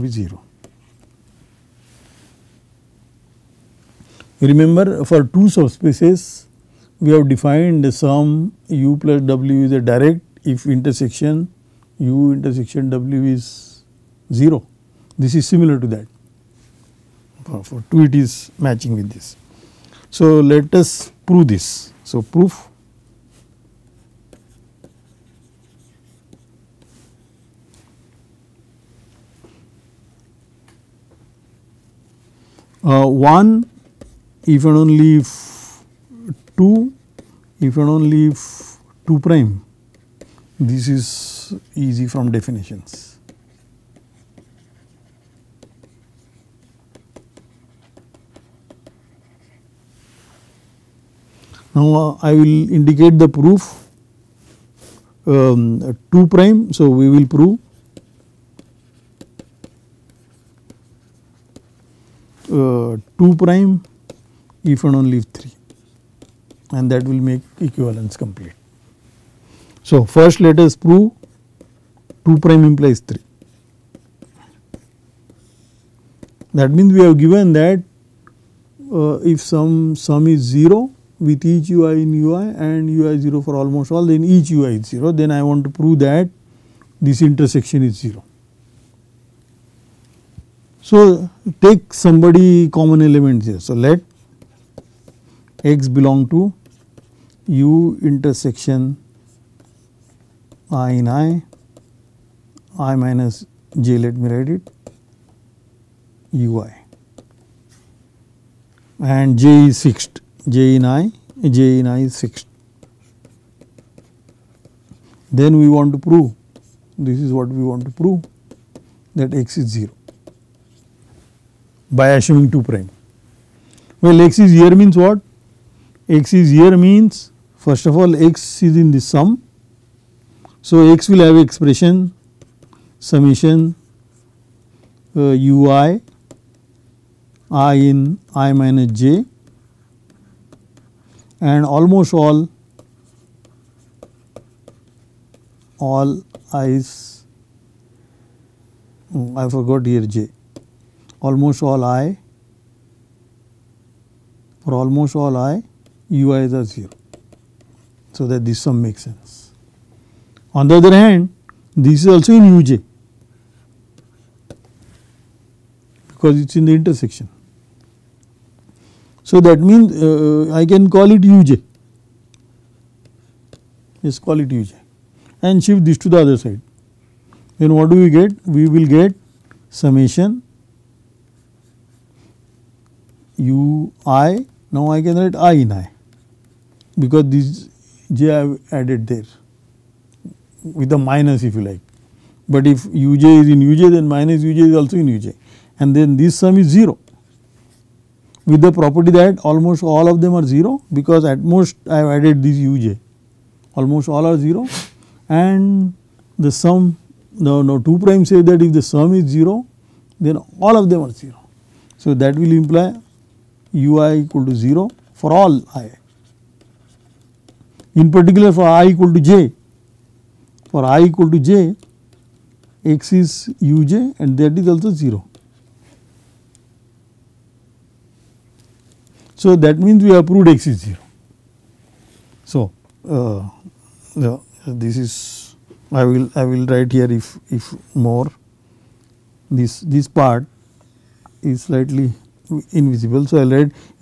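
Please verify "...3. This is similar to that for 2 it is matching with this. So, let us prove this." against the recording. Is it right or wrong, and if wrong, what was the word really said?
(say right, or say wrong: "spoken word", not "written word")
wrong: "0", not "3".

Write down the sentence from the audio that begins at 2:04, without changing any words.
Well x is here means what?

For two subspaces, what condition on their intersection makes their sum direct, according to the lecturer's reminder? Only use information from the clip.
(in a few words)
Intersection is 0.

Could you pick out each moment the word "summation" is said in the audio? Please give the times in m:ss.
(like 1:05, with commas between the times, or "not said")
2:13, 2:59.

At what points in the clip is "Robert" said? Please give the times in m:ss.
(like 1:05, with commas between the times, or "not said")
not said.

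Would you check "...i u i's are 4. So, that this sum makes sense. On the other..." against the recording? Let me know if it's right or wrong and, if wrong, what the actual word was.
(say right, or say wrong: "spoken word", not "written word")
wrong: "0", not "4".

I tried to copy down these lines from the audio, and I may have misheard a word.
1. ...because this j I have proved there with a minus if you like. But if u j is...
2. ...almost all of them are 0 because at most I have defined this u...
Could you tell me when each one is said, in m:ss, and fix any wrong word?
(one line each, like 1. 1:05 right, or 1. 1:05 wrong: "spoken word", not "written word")
1. 3:06 wrong: "added", not "proved"
2. 3:19 wrong: "added", not "defined".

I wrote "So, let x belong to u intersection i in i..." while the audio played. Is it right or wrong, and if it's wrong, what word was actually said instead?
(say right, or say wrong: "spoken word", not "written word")
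right.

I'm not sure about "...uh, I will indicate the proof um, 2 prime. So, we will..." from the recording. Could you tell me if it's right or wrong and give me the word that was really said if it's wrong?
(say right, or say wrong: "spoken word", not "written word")
right.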